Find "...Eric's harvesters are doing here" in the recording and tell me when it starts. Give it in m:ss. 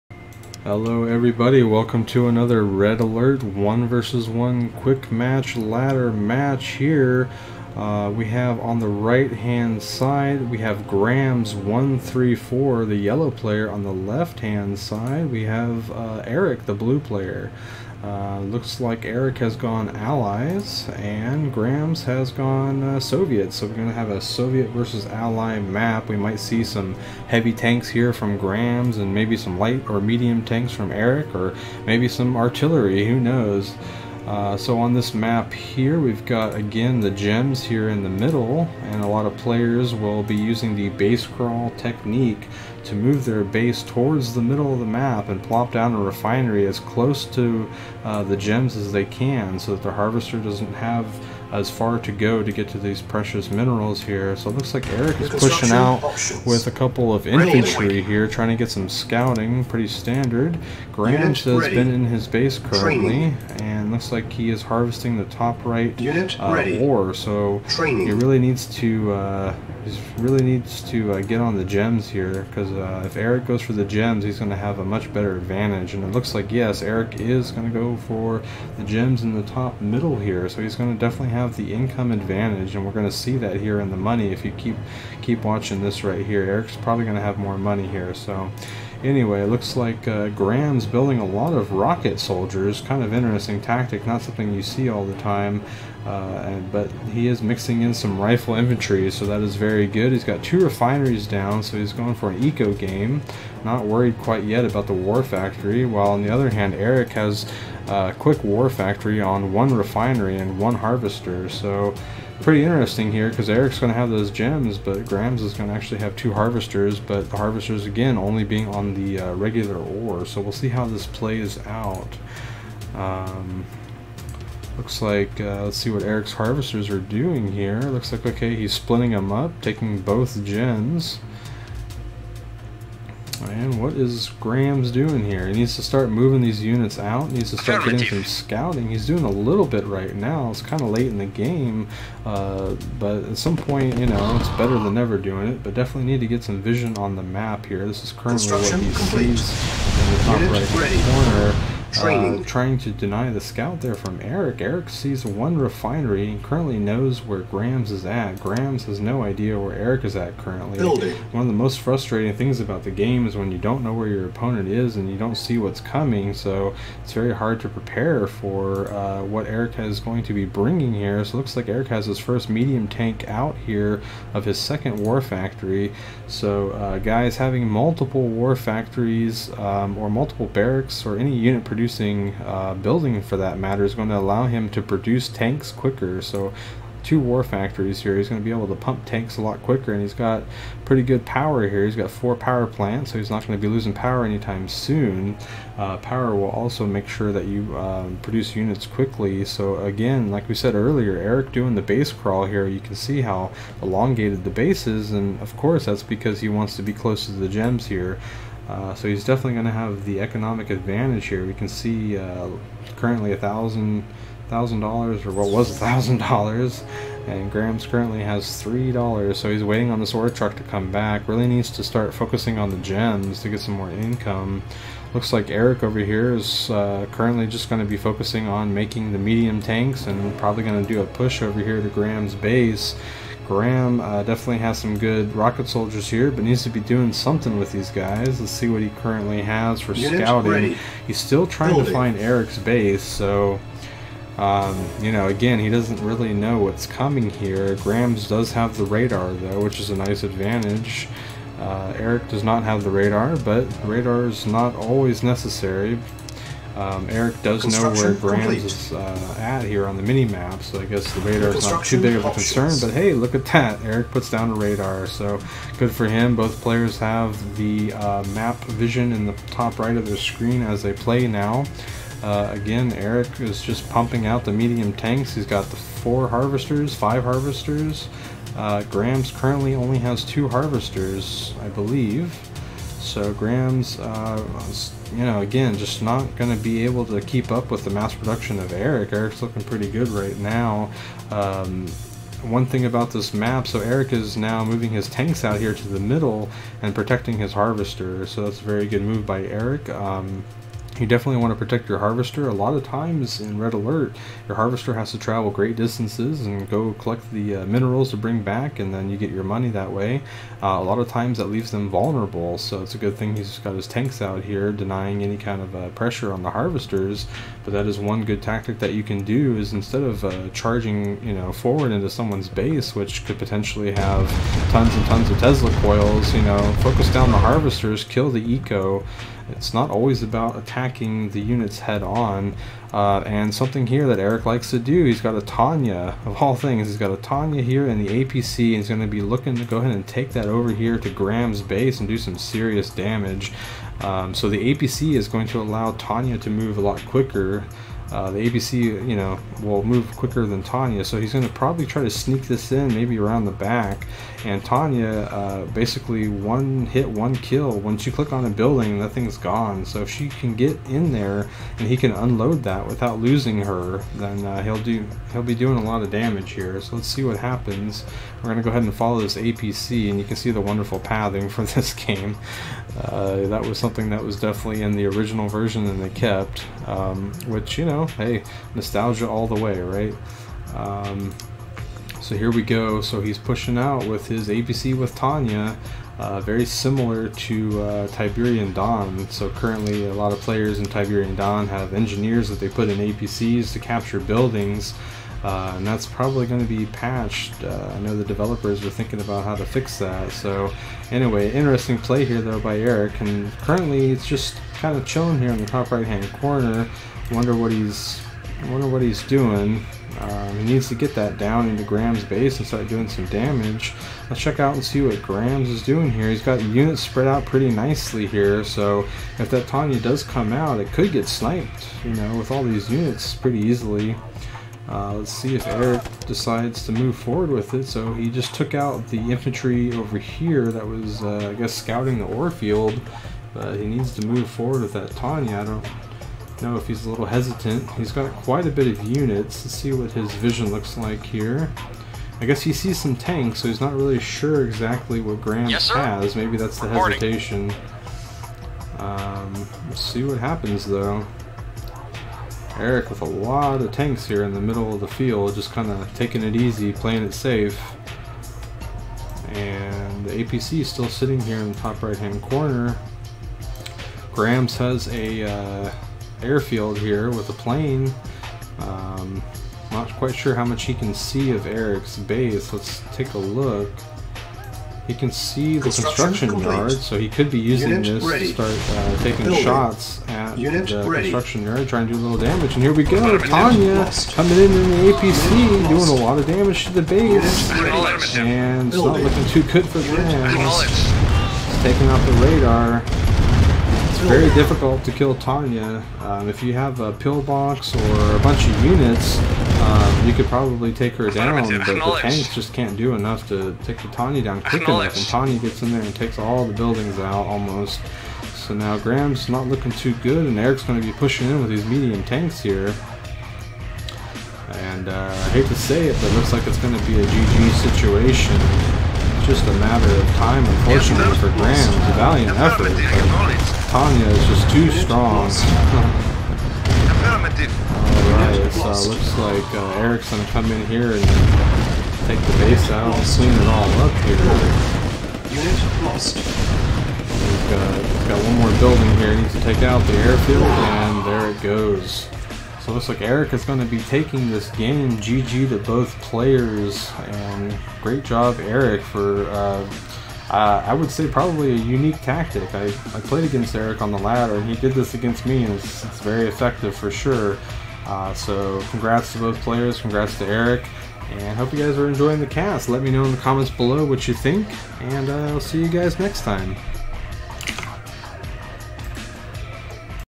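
2:06.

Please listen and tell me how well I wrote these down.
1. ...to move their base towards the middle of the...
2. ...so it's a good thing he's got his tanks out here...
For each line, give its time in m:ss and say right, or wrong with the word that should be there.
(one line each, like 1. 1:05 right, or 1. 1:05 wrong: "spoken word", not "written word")
1. 0:42 right
2. 5:12 right.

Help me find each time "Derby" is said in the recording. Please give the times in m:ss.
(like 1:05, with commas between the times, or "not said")
not said.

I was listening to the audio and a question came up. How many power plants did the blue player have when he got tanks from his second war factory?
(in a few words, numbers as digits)
4.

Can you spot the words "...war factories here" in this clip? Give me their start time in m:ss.
3:07.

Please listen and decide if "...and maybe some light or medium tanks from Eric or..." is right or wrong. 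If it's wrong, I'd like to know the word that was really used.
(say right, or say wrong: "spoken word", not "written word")
right.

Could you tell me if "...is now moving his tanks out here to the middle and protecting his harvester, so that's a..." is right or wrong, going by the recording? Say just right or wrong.
right.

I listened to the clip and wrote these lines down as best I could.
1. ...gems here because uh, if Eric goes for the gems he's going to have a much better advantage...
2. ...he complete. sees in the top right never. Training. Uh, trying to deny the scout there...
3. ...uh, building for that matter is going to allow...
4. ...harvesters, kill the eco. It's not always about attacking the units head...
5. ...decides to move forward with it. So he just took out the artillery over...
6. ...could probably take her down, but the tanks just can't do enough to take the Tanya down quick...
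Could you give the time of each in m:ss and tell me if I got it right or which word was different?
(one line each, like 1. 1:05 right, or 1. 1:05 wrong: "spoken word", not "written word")
1. 1:11 right
2. 2:28 wrong: "corner", not "never"
3. 3:02 right
4. 5:27 right
5. 7:06 wrong: "infantry", not "artillery"
6. 8:20 right.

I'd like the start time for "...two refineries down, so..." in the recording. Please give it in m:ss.
1:40.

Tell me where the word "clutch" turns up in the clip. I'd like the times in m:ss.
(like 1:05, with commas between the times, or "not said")
not said.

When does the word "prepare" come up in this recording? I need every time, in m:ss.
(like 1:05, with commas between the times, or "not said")
2:47.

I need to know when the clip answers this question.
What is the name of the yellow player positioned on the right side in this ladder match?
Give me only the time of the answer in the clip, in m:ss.
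0:10.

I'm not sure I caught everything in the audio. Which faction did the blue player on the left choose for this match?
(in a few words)
Allies.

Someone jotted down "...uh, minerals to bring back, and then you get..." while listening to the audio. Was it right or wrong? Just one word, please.
right.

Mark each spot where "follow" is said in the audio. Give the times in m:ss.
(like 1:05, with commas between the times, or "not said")
6:08.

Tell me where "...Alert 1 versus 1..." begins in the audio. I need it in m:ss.
0:02.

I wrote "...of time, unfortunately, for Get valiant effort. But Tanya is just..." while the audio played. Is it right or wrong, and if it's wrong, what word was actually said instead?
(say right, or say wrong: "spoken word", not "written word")
wrong: "Grams", not "Get".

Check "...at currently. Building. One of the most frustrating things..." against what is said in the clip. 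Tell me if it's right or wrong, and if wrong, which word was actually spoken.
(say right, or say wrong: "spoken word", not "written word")
right.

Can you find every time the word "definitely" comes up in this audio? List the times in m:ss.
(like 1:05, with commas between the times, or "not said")
1:20, 2:25, 3:29, 3:54, 5:01, 6:14.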